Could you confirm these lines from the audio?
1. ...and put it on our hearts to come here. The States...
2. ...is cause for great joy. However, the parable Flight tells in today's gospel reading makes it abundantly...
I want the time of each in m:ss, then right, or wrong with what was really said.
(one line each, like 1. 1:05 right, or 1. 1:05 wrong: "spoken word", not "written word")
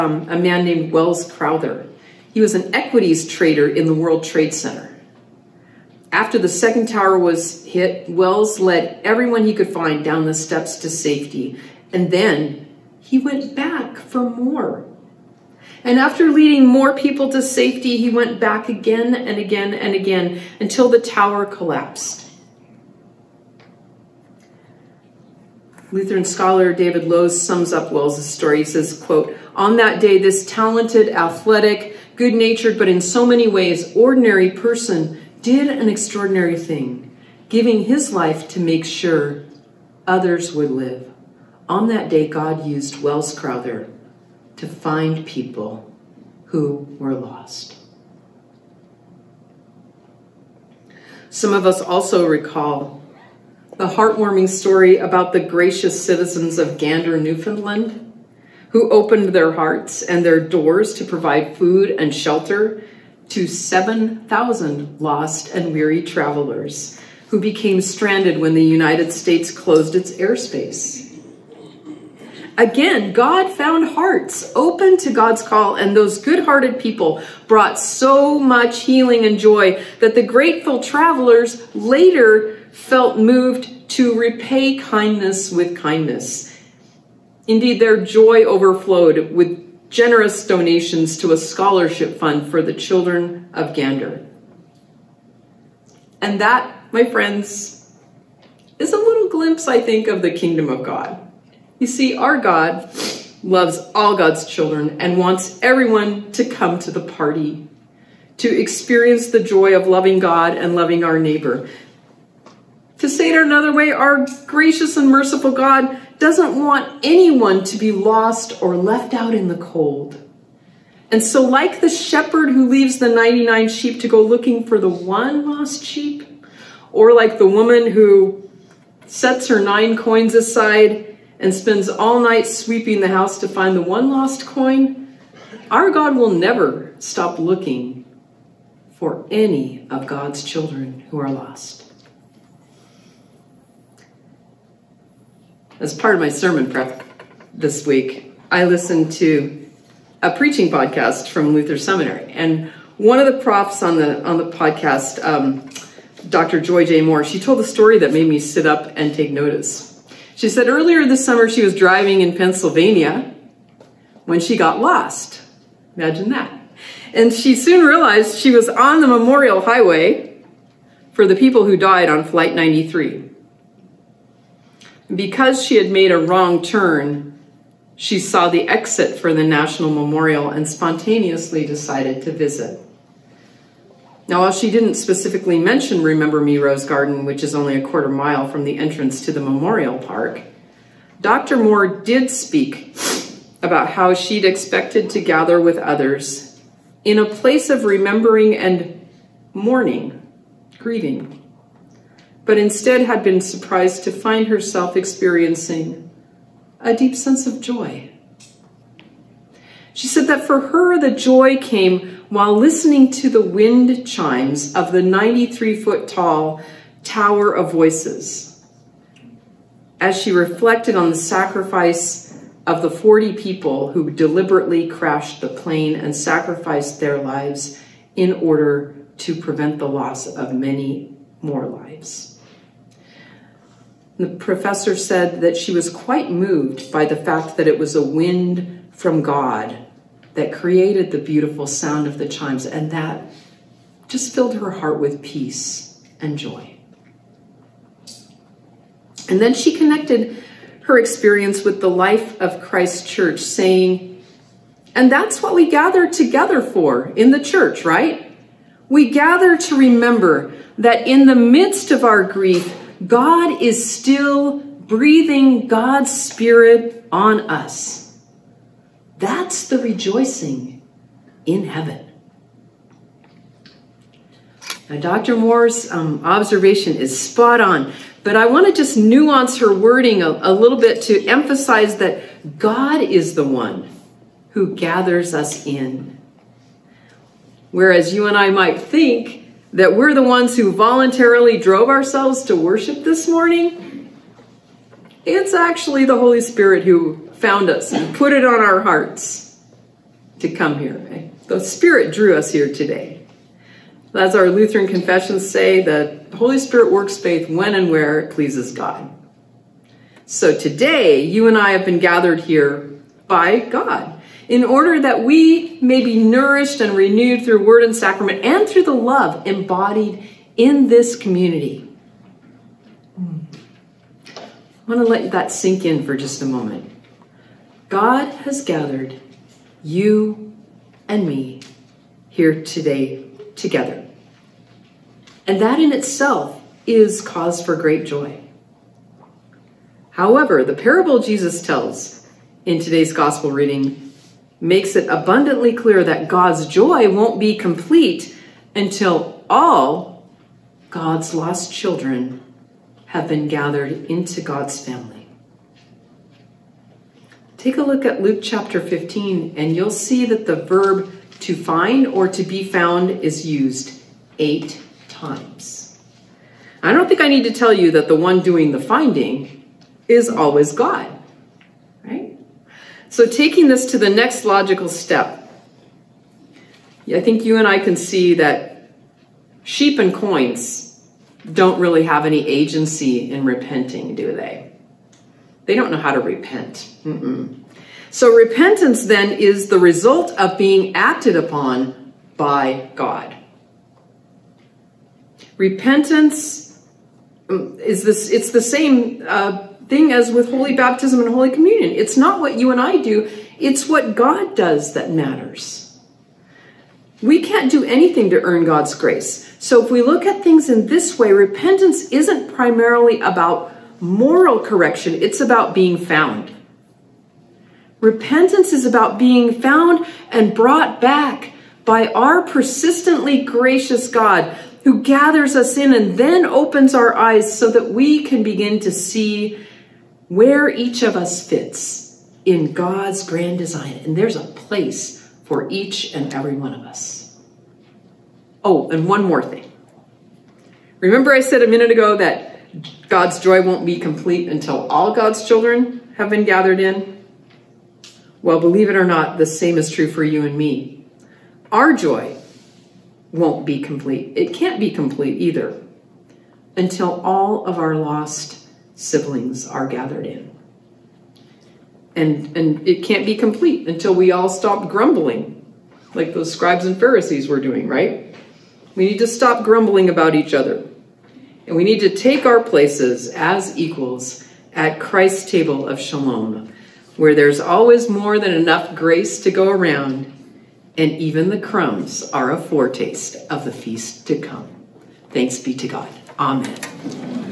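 1. 4:57 wrong: "Spirit", not "States"
2. 5:36 wrong: "Jesus", not "Flight".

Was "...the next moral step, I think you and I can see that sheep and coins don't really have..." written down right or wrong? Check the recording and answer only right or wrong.
wrong.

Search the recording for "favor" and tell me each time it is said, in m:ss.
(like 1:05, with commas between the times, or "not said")
not said.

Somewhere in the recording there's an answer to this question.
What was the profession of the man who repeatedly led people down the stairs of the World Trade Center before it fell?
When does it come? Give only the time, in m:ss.
0:02.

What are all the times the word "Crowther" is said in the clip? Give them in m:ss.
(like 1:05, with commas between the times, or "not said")
0:01, 0:43.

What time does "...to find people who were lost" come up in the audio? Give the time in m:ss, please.
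0:44.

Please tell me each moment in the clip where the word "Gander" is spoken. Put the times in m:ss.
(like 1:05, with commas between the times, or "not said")
0:56, 1:33.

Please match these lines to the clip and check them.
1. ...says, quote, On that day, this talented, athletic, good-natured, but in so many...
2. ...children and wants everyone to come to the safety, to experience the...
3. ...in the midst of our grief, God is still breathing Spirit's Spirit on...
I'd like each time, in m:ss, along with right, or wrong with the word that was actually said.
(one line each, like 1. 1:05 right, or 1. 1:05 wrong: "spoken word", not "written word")
1. 0:28 right
2. 1:44 wrong: "party", not "safety"
3. 4:21 wrong: "God", not "Spirit".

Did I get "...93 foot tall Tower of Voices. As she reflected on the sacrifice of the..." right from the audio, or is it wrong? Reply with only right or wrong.
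right.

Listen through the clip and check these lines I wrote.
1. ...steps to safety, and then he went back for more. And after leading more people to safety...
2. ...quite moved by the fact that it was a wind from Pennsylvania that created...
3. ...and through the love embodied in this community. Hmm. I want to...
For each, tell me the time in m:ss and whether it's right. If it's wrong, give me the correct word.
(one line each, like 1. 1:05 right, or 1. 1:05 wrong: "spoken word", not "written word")
1. 0:10 right
2. 3:55 wrong: "God", not "Pennsylvania"
3. 5:18 right.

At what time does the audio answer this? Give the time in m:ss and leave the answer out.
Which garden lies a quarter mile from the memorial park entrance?
3:06.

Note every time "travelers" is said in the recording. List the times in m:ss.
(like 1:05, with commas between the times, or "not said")
1:06, 1:20.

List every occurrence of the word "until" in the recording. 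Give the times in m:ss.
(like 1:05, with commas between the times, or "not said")
0:20, 5:48, 7:24, 7:36, 7:43.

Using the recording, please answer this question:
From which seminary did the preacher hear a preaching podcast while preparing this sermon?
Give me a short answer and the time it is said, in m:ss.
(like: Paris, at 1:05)
Luther Seminary, at 2:31.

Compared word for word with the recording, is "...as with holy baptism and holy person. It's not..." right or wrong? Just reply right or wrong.
wrong.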